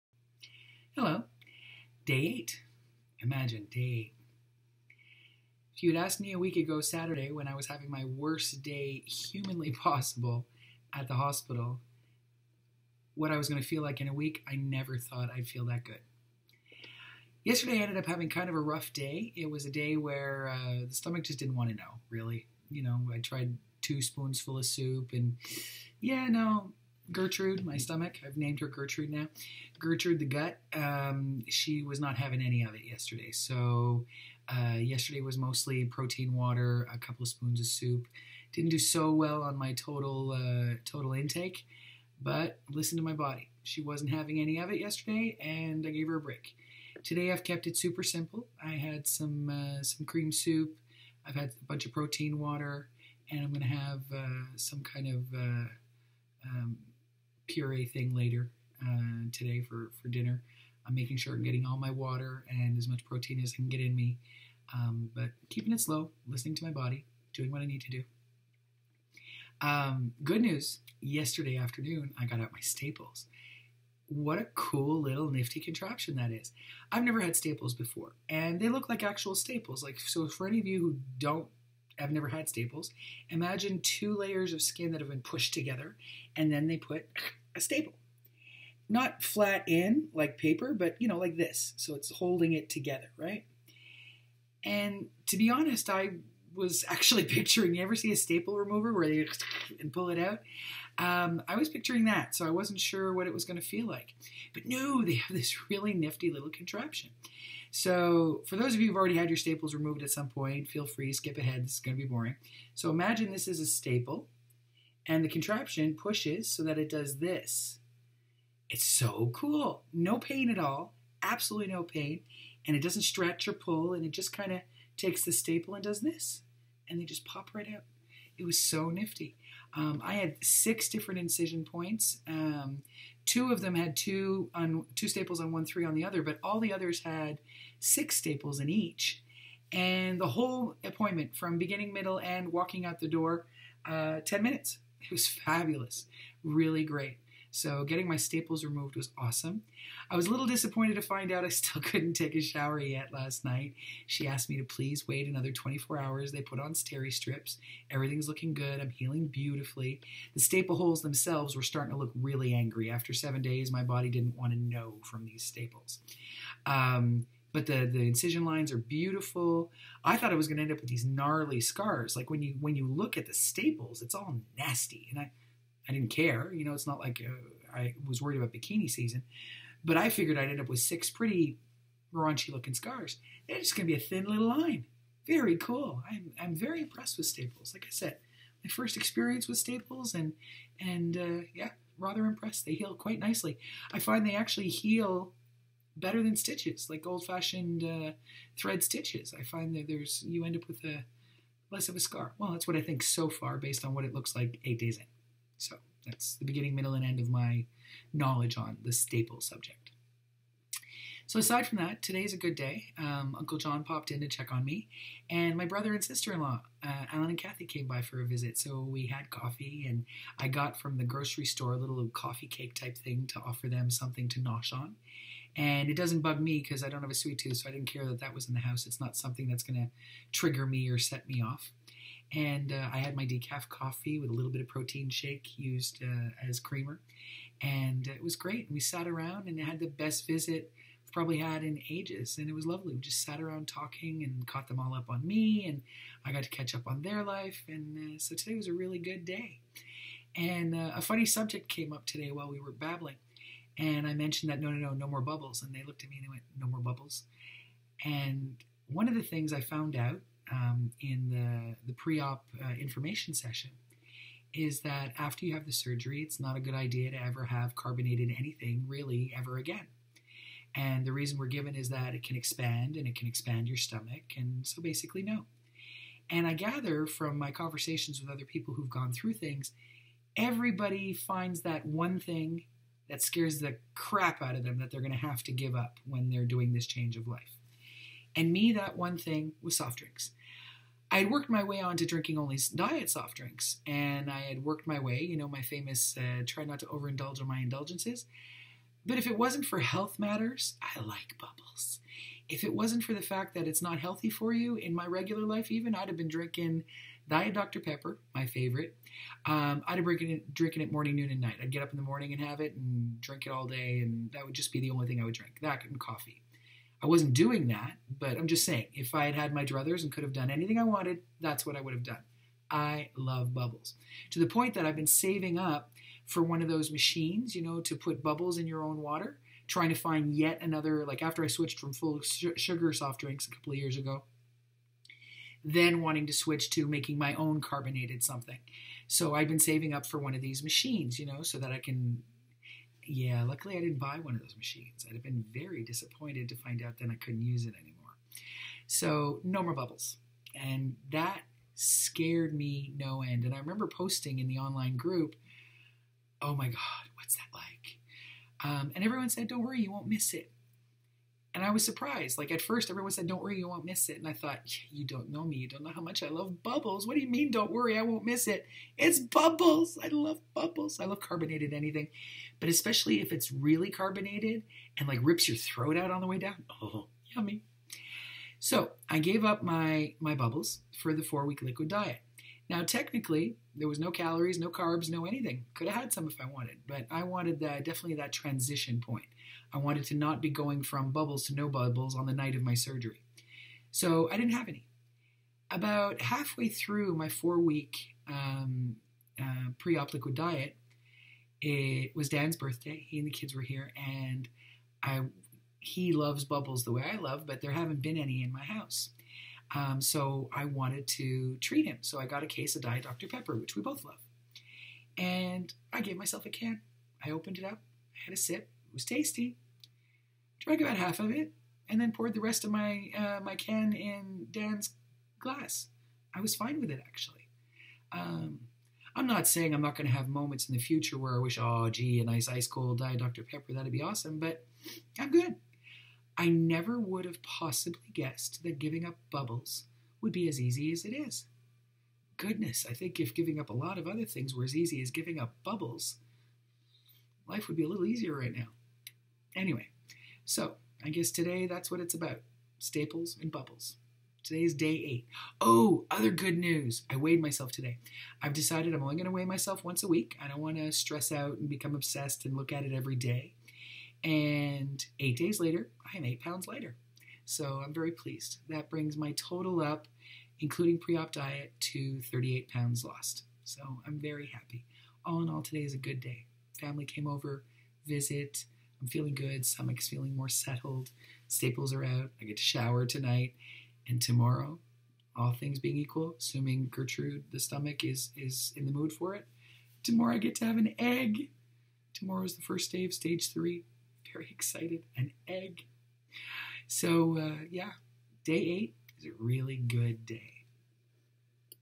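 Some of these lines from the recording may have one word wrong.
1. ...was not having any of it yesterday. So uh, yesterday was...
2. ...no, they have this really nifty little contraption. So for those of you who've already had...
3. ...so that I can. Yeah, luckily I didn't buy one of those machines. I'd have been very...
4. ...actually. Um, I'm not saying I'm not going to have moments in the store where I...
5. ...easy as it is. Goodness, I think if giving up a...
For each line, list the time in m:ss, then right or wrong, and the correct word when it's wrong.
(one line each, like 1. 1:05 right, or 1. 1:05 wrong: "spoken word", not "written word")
1. 0:31 right
2. 1:44 right
3. 5:41 right
4. 7:07 wrong: "future", not "store"
5. 7:20 right.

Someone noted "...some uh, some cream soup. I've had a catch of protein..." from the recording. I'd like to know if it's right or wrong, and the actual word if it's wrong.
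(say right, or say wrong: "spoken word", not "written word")
wrong: "bunch", not "catch".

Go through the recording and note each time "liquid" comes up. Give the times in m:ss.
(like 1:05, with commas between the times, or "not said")
6:21, 6:40.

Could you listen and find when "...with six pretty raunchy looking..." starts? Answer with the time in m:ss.
3:00.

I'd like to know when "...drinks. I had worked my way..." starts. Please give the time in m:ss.
4:49.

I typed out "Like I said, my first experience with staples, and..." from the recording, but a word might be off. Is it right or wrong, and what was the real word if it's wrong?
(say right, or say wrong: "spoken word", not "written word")
right.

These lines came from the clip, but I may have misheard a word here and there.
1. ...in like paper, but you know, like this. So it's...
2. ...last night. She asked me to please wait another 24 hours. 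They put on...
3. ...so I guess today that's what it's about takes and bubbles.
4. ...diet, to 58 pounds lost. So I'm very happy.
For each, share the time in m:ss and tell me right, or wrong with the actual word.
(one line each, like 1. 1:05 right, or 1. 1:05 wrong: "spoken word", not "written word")
1. 1:29 right
2. 2:33 right
3. 7:30 wrong: "staples", not "takes"
4. 7:51 wrong: "38", not "58".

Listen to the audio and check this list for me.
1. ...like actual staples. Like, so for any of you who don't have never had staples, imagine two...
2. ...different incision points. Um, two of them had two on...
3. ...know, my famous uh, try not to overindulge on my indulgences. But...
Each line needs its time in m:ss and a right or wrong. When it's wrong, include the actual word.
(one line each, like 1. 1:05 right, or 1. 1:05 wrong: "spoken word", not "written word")
1. 1:18 right
2. 2:10 right
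3. 4:55 right.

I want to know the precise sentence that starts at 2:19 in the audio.
And the whole appointment, from beginning, middle, and walking out the door, uh, ten minutes.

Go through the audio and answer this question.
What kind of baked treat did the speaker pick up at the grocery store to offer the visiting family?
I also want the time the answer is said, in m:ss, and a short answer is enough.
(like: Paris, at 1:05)
coffee cake, at 3:42.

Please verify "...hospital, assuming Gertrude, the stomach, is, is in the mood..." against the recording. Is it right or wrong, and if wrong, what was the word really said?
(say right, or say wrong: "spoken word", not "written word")
wrong: "equal", not "hospital".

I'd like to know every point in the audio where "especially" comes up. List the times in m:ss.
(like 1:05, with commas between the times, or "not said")
6:12.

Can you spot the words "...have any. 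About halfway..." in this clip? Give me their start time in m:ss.
6:34.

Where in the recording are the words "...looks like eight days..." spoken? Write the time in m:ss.
3:24.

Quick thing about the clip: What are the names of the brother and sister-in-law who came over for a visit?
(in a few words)
Alan and Kathy.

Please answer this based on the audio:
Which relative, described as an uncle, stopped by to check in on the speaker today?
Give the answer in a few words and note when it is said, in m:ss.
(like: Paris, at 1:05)
Uncle John, at 3:33.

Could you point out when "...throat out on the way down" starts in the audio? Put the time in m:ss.
6:15.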